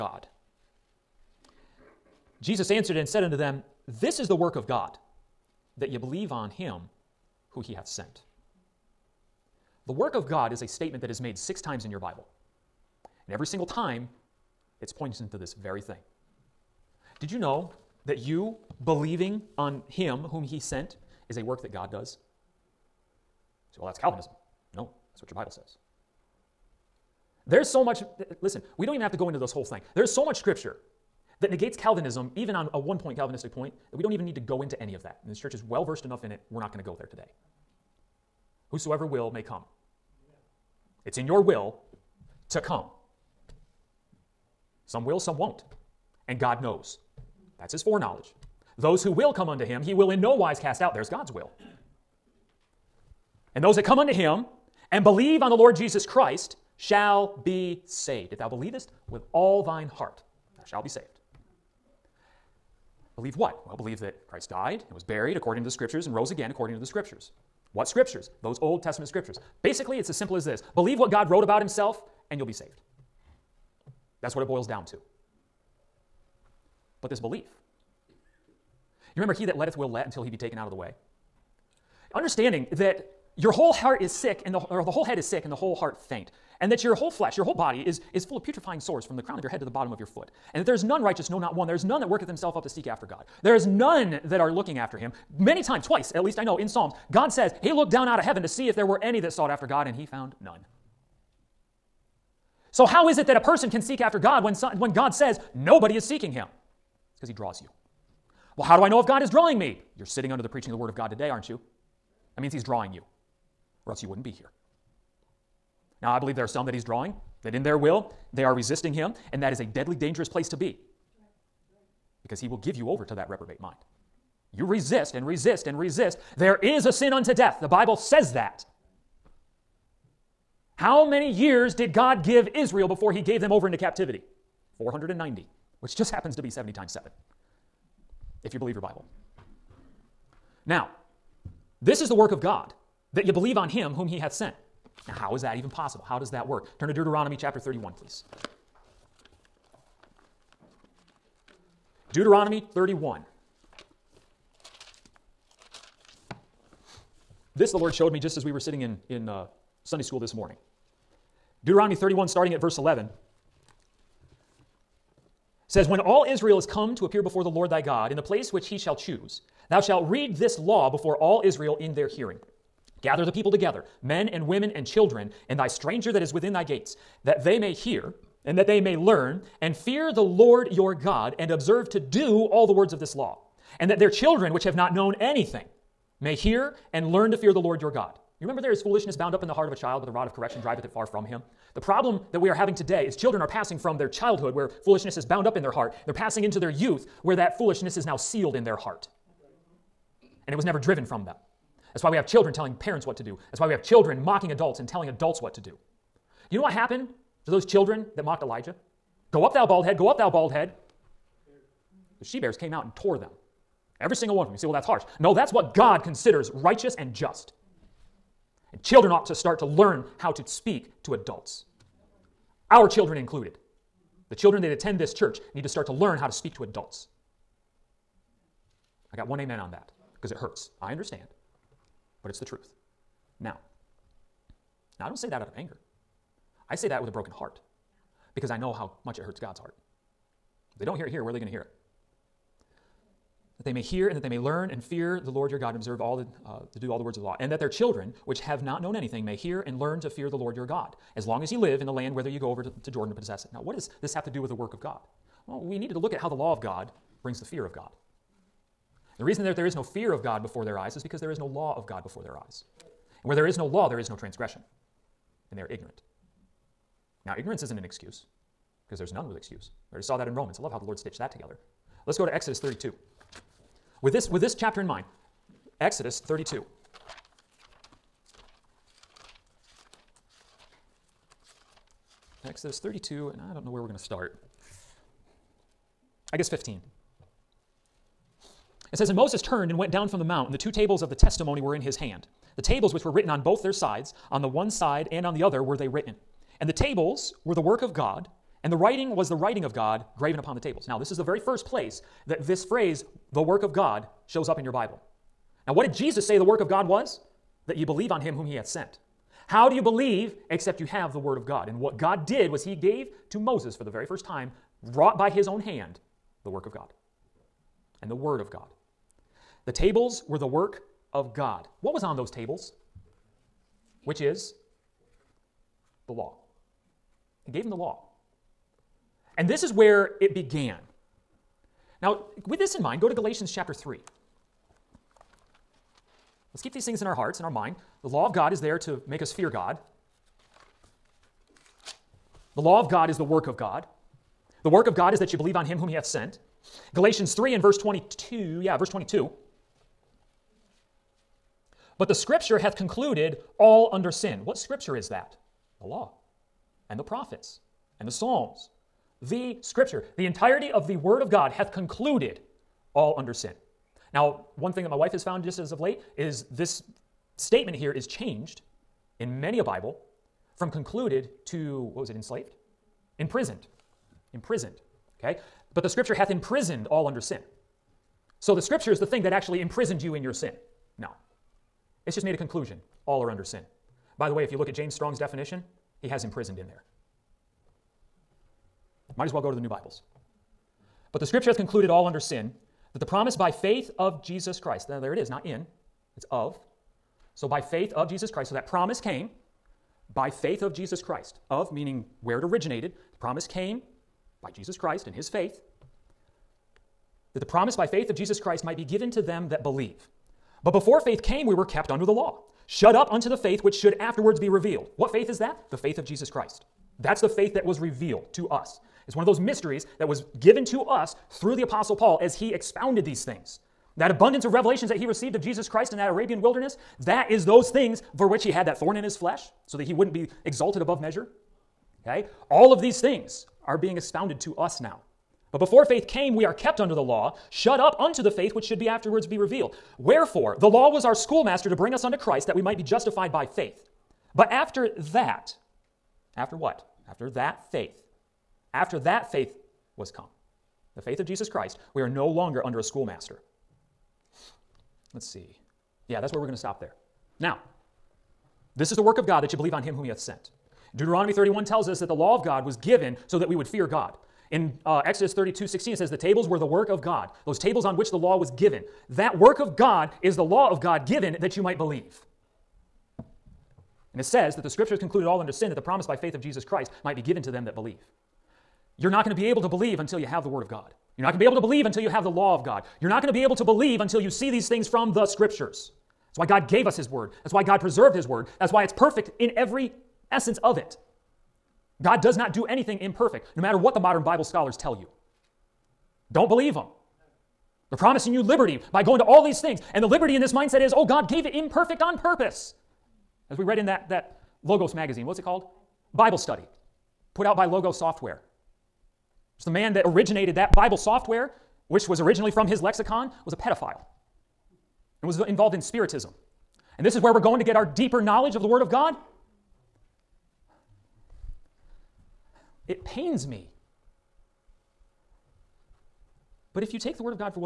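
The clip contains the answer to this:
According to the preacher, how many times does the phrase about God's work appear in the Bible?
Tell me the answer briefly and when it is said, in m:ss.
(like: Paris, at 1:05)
6, at 0:11.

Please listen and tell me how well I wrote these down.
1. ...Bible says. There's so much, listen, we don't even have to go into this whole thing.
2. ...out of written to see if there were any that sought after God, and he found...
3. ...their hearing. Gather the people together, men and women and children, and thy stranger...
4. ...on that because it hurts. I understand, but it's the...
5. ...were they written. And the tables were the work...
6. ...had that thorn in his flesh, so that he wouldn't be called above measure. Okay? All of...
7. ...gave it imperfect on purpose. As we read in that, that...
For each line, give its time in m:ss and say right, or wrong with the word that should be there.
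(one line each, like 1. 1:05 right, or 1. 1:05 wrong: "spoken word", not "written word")
1. 0:25 right
2. 1:38 wrong: "heaven", not "written"
3. 2:51 right
4. 3:49 right
5. 4:55 right
6. 7:08 wrong: "exalted", not "called"
7. 8:21 right.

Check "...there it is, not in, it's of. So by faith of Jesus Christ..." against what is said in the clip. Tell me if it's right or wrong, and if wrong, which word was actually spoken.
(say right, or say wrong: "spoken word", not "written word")
right.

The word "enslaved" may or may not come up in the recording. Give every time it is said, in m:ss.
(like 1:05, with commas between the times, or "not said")
6:12.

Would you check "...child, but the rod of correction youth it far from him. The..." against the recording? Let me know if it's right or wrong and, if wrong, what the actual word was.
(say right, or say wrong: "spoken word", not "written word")
wrong: "driveth", not "youth".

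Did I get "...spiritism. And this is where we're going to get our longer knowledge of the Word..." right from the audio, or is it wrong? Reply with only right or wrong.
wrong.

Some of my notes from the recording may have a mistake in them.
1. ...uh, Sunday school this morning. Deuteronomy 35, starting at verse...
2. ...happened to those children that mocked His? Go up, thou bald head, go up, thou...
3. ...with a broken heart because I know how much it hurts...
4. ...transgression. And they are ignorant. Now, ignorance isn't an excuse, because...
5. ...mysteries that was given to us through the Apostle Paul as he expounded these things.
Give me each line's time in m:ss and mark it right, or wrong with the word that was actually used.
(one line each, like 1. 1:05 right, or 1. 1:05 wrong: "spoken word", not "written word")
1. 2:39 wrong: "31", not "35"
2. 3:26 wrong: "Elijah", not "His"
3. 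3:57 right
4. 4:24 right
5. 6:59 right.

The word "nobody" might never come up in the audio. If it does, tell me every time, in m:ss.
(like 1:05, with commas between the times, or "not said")
1:45.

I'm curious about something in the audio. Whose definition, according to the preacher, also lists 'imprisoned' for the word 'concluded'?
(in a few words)
James Strong.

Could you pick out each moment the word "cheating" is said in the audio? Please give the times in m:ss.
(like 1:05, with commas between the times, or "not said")
not said.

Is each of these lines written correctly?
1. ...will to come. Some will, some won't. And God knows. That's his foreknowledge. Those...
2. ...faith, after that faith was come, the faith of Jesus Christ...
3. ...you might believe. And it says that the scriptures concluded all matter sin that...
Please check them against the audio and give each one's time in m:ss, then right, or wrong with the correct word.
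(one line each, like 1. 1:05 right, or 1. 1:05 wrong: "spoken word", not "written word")
1. 0:41 right
2. 7:27 right
3. 7:51 wrong: "under", not "matter".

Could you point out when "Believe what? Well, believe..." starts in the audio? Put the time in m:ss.
1:03.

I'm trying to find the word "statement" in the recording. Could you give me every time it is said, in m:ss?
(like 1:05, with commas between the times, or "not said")
0:10, 6:07.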